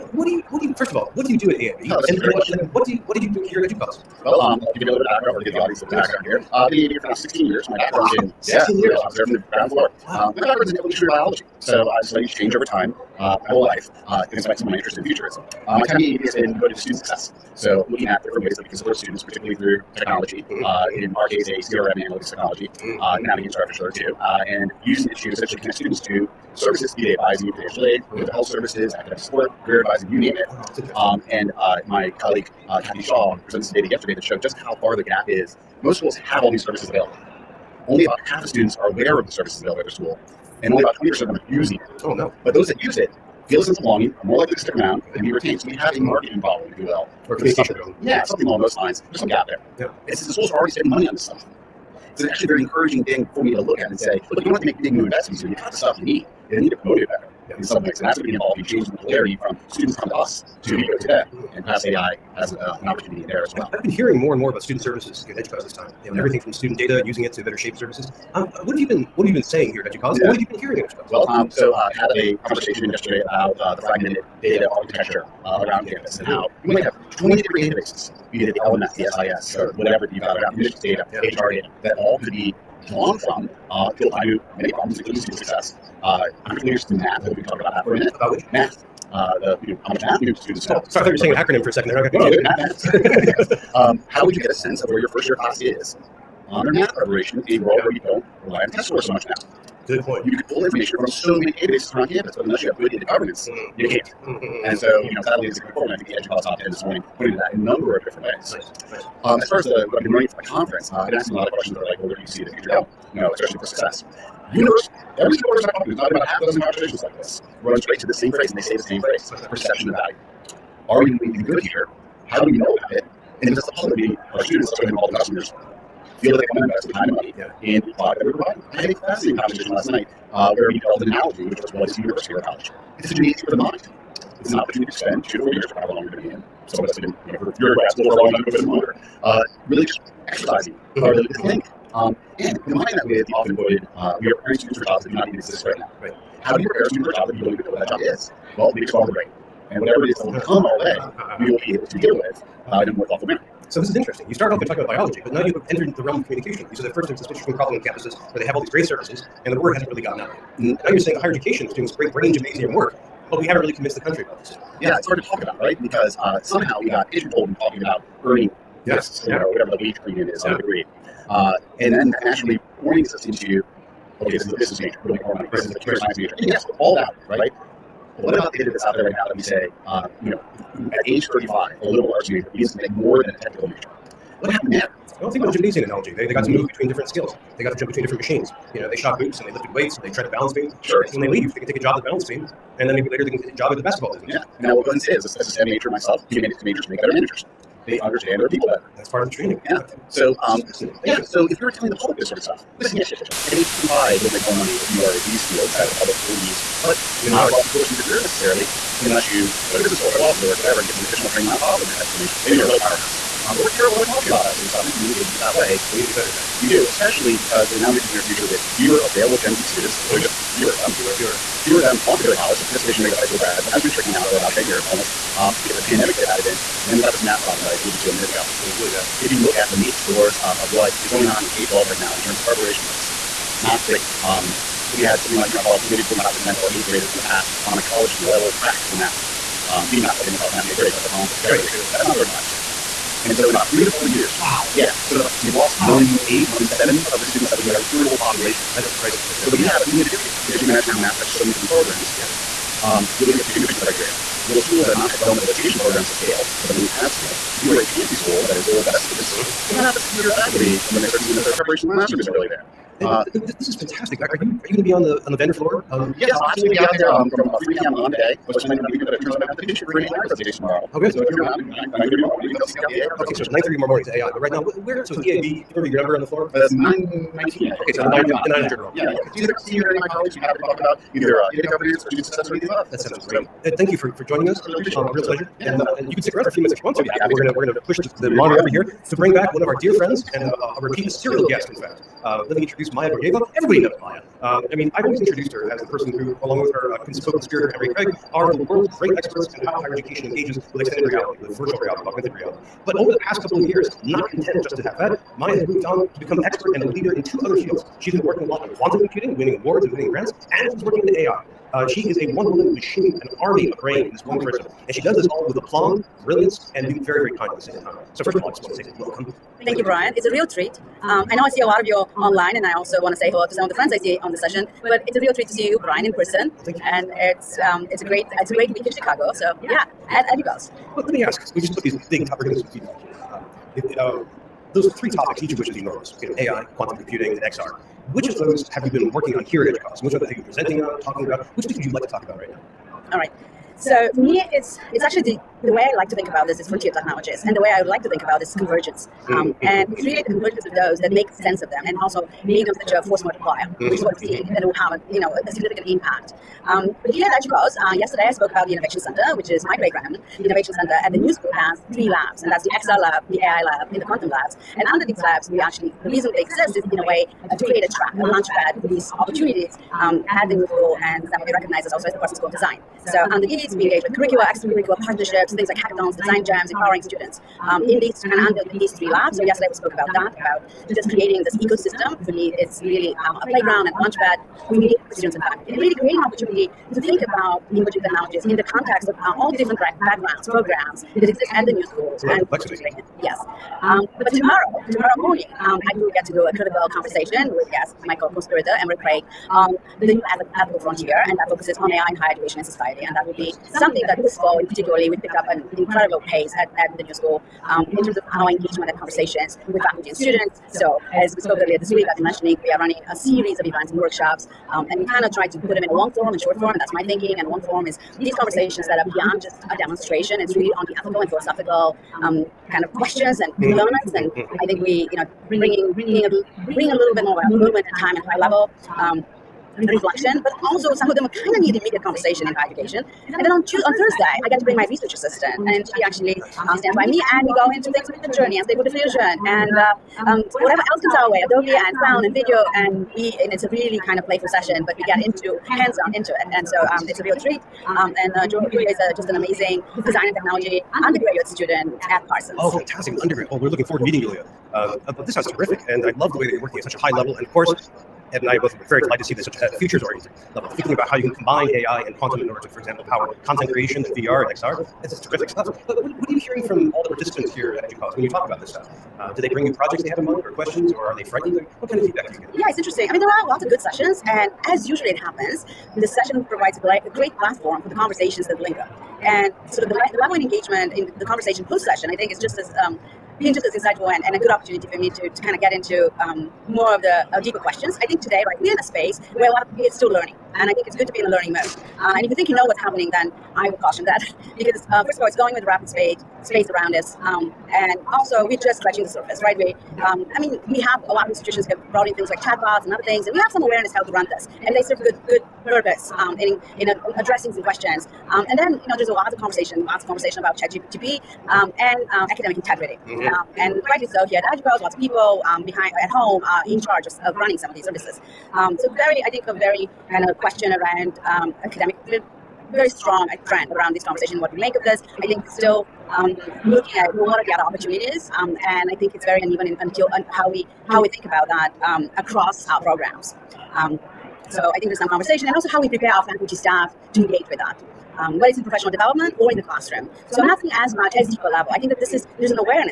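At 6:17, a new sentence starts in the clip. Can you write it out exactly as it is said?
Um, in these and under these three labs, so yesterday we spoke about that, about just creating this ecosystem.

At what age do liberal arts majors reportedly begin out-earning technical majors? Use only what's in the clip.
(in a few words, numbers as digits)
35.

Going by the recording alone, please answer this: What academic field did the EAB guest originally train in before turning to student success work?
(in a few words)
evolutionary biology.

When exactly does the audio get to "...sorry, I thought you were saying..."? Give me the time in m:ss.
1:30.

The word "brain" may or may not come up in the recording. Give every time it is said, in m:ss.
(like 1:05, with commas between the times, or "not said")
2:29, 2:42, 5:13.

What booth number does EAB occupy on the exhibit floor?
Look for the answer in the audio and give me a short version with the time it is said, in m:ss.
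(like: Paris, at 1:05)
919, at 4:36.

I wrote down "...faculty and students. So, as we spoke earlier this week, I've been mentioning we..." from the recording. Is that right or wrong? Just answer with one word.
right.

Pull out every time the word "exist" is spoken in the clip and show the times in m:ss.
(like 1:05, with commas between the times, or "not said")
2:25, 6:06, 6:31.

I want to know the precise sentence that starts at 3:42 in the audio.
The participation rate of high school grads has been shrinking now for about 10 years almost.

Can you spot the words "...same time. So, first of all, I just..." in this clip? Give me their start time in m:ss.
5:17.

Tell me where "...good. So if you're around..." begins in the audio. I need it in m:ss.
4:30.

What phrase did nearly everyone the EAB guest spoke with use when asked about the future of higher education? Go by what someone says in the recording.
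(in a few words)
perception of value.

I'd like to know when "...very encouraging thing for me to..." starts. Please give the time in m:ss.
0:52.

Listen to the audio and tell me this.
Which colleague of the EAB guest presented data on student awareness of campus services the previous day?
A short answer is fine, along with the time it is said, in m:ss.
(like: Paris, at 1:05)
Kathy Shaw, at 0:32.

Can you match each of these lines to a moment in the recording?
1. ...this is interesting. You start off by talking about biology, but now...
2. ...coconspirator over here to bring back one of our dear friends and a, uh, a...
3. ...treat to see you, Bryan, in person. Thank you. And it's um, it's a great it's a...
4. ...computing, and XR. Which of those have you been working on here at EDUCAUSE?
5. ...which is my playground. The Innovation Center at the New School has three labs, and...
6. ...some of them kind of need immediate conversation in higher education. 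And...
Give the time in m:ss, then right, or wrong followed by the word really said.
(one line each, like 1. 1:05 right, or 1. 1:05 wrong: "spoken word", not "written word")
1. 2:33 right
2. 4:48 wrong: "monitor", not "coconspirator"
3. 5:25 right
4. 5:36 right
5. 5:59 right
6. 7:10 right.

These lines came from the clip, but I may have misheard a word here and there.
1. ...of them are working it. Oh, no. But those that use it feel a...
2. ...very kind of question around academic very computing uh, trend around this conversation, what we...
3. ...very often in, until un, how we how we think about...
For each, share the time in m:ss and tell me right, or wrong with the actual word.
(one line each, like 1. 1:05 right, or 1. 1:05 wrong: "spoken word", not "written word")
1. 0:41 wrong: "using", not "working"
2. 8:39 wrong: "strong", not "computing"
3. 8:49 wrong: "uneven", not "often".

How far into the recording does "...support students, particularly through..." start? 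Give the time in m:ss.
0:18.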